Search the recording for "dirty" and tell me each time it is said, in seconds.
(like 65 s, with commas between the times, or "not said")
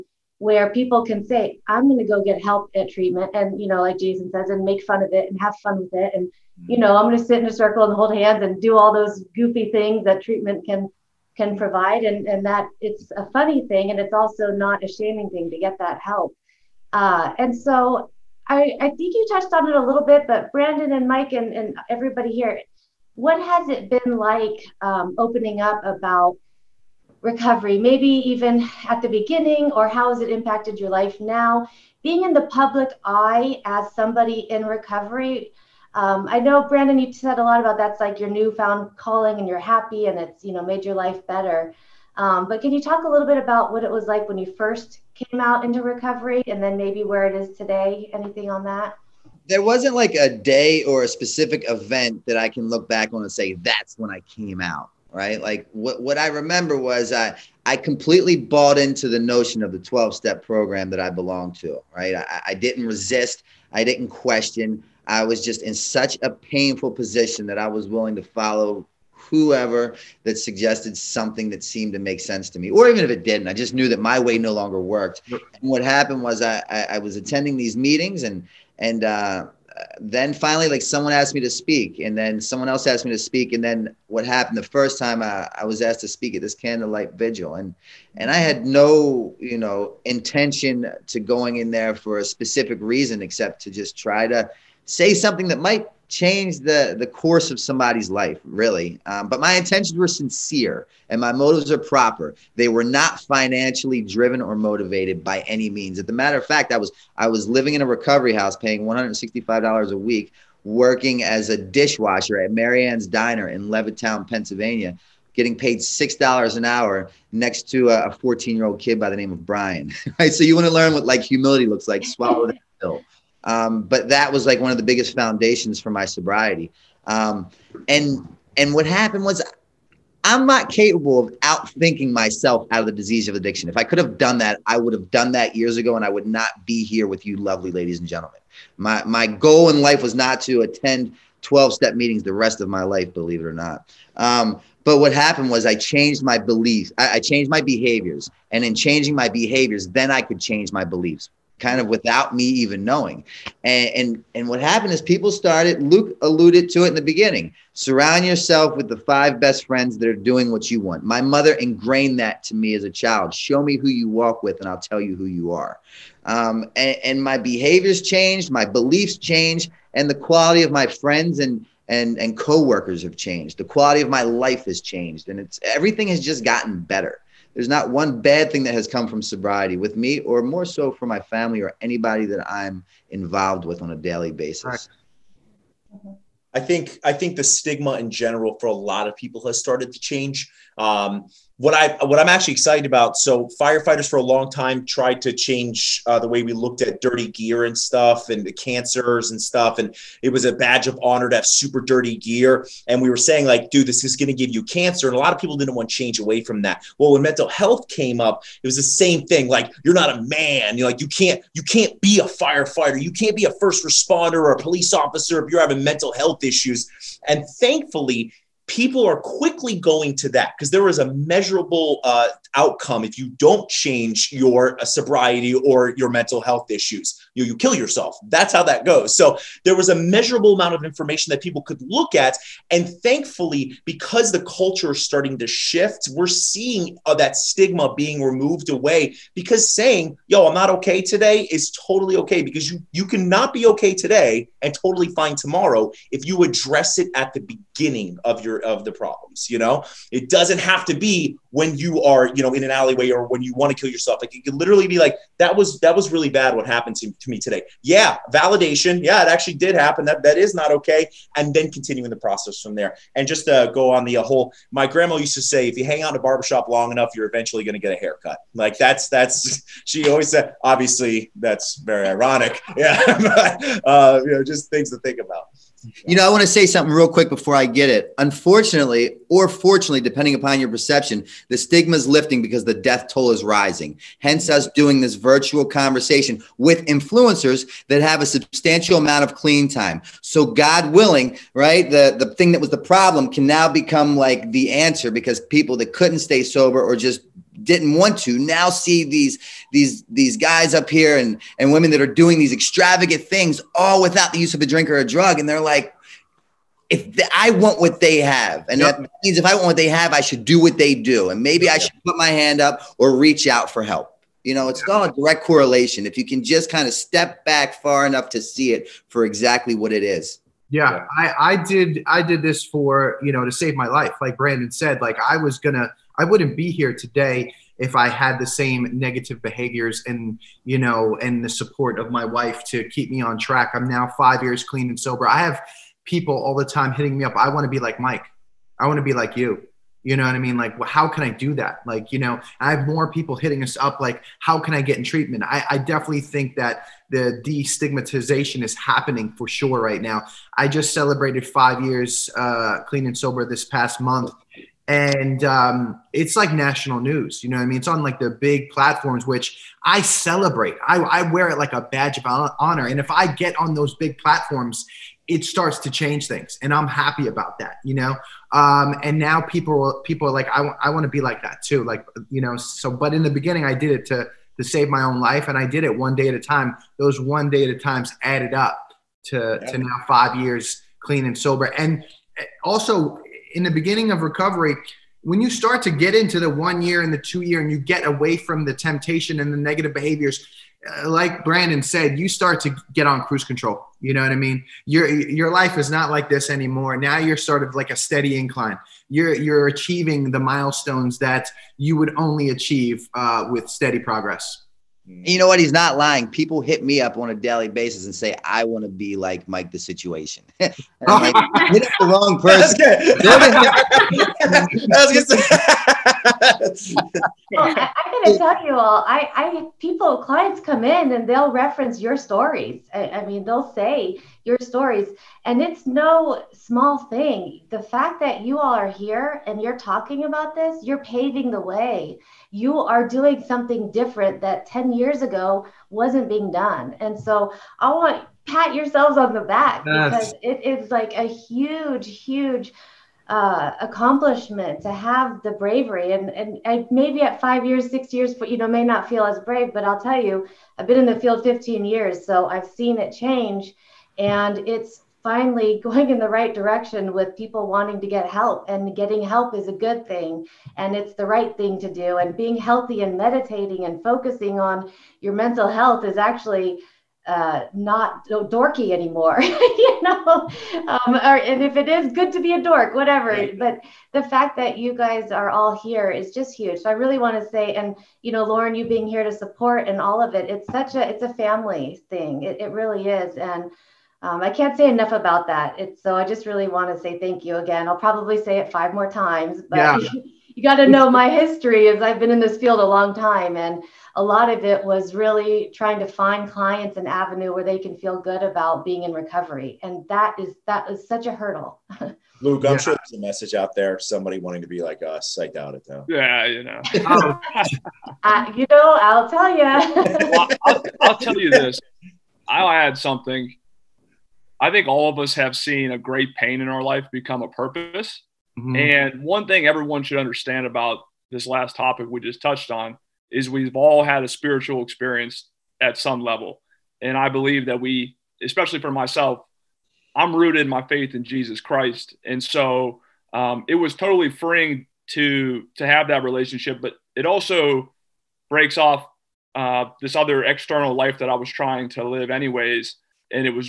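197 s, 201 s.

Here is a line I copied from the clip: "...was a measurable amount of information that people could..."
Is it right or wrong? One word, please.
right.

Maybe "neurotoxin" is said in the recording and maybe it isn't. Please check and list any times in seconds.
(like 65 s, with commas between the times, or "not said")
not said.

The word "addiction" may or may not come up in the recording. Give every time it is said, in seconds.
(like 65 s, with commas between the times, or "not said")
133 s.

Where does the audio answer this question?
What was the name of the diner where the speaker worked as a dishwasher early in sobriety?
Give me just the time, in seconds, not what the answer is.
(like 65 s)
112 s.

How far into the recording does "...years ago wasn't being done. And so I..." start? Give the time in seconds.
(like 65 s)
434 s.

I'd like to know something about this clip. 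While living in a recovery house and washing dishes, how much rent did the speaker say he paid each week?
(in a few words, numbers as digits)
$165.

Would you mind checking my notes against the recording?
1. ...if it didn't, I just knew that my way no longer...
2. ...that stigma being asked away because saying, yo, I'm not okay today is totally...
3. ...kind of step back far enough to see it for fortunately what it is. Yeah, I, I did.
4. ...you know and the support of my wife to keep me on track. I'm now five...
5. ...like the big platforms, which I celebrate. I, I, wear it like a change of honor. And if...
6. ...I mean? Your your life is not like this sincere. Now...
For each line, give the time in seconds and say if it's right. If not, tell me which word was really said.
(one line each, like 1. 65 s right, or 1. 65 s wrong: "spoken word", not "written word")
1. 73 s right
2. 237 s wrong: "removed", not "asked"
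3. 316 s wrong: "exactly", not "fortunately"
4. 330 s right
5. 358 s wrong: "badge", not "change"
6. 394 s wrong: "anymore", not "sincere".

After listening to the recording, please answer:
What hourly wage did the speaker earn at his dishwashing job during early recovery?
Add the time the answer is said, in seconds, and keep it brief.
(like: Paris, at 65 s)
$6, at 115 s.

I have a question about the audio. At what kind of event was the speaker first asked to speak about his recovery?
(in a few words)
Candlelight vigil.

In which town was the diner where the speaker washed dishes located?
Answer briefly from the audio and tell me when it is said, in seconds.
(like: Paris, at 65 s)
Levittown, Pennsylvania, at 113 s.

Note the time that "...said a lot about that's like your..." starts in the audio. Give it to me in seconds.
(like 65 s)
37 s.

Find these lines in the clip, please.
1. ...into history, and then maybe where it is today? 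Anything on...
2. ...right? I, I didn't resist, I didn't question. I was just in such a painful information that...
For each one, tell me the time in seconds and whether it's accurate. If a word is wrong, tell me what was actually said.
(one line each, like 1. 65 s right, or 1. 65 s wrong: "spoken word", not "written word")
1. 45 s wrong: "recovery", not "history"
2. 61 s wrong: "position", not "information".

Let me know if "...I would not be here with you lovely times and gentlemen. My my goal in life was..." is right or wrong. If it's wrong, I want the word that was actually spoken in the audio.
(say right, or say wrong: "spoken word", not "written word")
wrong: "ladies", not "times".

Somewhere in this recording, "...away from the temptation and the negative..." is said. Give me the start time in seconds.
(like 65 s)
388 s.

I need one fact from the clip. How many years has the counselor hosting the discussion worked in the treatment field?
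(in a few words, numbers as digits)
15 years.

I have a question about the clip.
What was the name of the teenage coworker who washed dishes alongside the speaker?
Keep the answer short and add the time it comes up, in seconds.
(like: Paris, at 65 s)
Brian, at 119 s.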